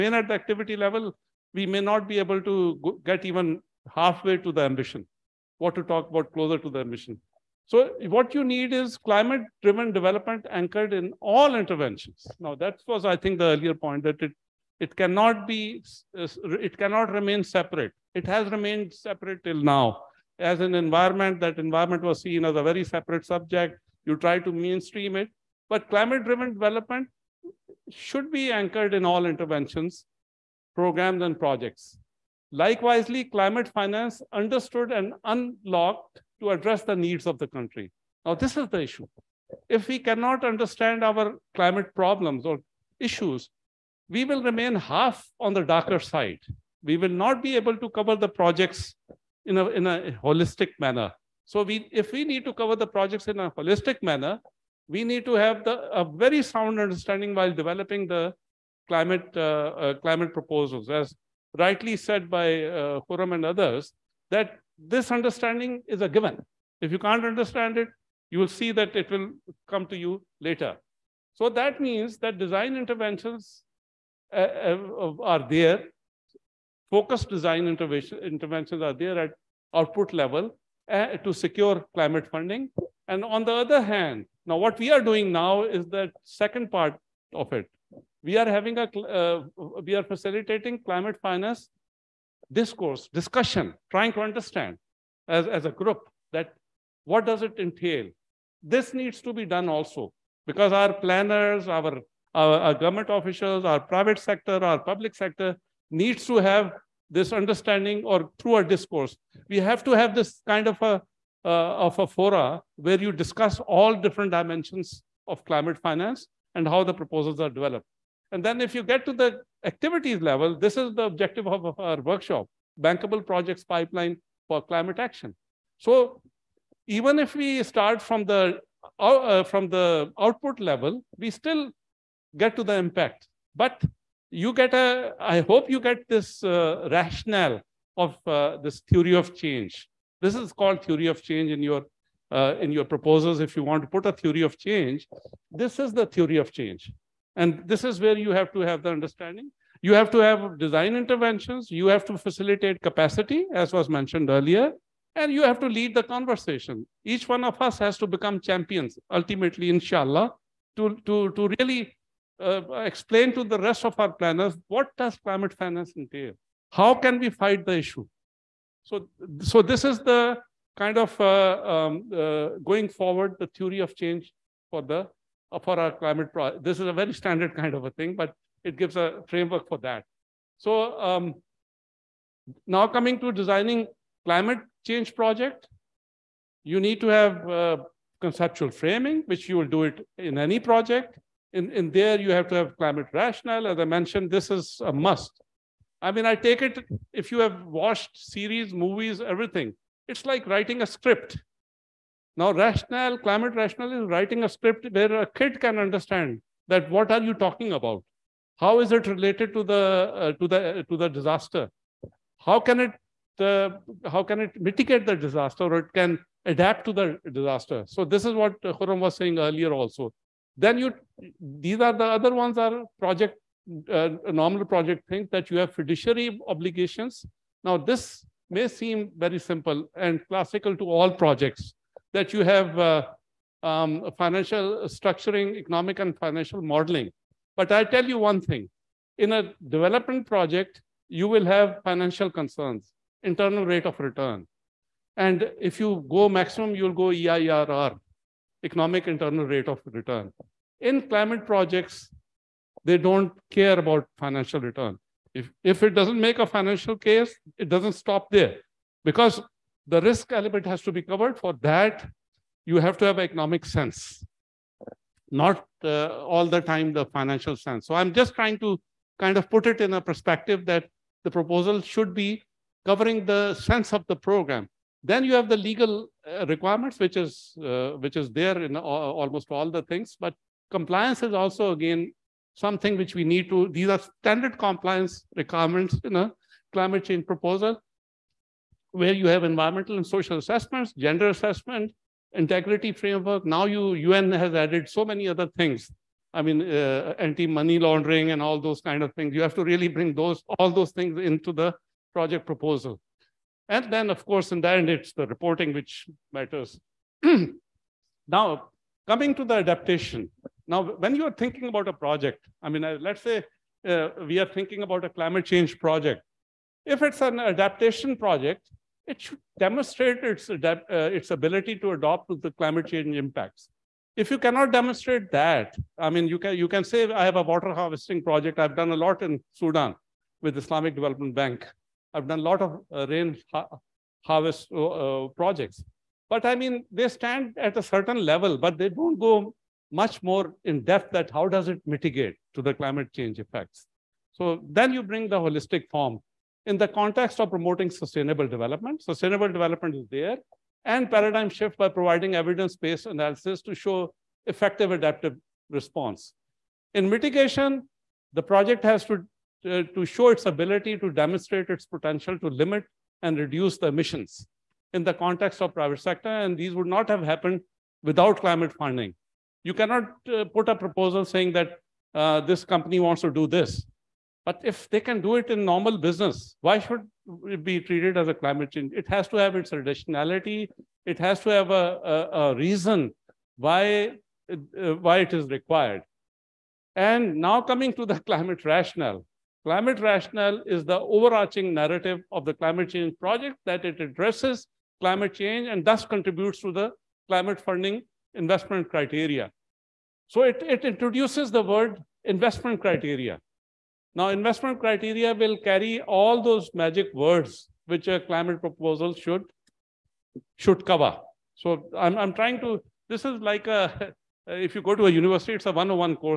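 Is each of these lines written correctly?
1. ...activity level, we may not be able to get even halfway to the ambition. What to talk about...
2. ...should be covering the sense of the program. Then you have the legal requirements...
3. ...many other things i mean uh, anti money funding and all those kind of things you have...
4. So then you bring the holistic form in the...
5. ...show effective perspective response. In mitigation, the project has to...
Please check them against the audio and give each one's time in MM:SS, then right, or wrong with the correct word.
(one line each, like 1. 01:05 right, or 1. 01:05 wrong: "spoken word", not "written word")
1. 00:00 right
2. 04:31 right
3. 04:55 wrong: "laundering", not "funding"
4. 05:44 right
5. 05:53 wrong: "adaptive", not "perspective".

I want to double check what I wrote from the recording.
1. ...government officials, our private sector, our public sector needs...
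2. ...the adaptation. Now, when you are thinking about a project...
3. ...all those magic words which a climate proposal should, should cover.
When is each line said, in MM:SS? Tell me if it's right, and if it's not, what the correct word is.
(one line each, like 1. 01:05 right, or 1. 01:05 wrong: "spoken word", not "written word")
1. 01:42 right
2. 05:09 right
3. 06:46 right.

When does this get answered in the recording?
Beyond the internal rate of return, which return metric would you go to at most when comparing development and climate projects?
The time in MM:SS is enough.
04:07.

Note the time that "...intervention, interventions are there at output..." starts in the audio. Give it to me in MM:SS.
01:17.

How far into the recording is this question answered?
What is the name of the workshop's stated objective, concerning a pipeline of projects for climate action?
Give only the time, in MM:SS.
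02:02.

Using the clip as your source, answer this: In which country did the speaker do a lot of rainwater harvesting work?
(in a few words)
Sudan.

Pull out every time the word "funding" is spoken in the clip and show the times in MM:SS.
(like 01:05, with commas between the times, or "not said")
01:22, 06:08, 06:37.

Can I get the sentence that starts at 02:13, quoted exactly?
But you get a, I hope you get this uh, rationale of uh, this theory of change.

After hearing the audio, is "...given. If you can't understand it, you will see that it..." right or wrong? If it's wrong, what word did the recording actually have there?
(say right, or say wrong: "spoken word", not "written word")
right.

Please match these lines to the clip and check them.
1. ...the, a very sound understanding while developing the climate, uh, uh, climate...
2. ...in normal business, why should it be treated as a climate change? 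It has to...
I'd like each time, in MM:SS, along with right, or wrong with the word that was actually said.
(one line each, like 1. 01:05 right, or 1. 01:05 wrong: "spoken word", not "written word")
1. 00:55 right
2. 06:15 right.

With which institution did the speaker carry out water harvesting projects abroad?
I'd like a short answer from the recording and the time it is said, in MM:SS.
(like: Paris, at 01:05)
Islamic Development Bank, at 05:30.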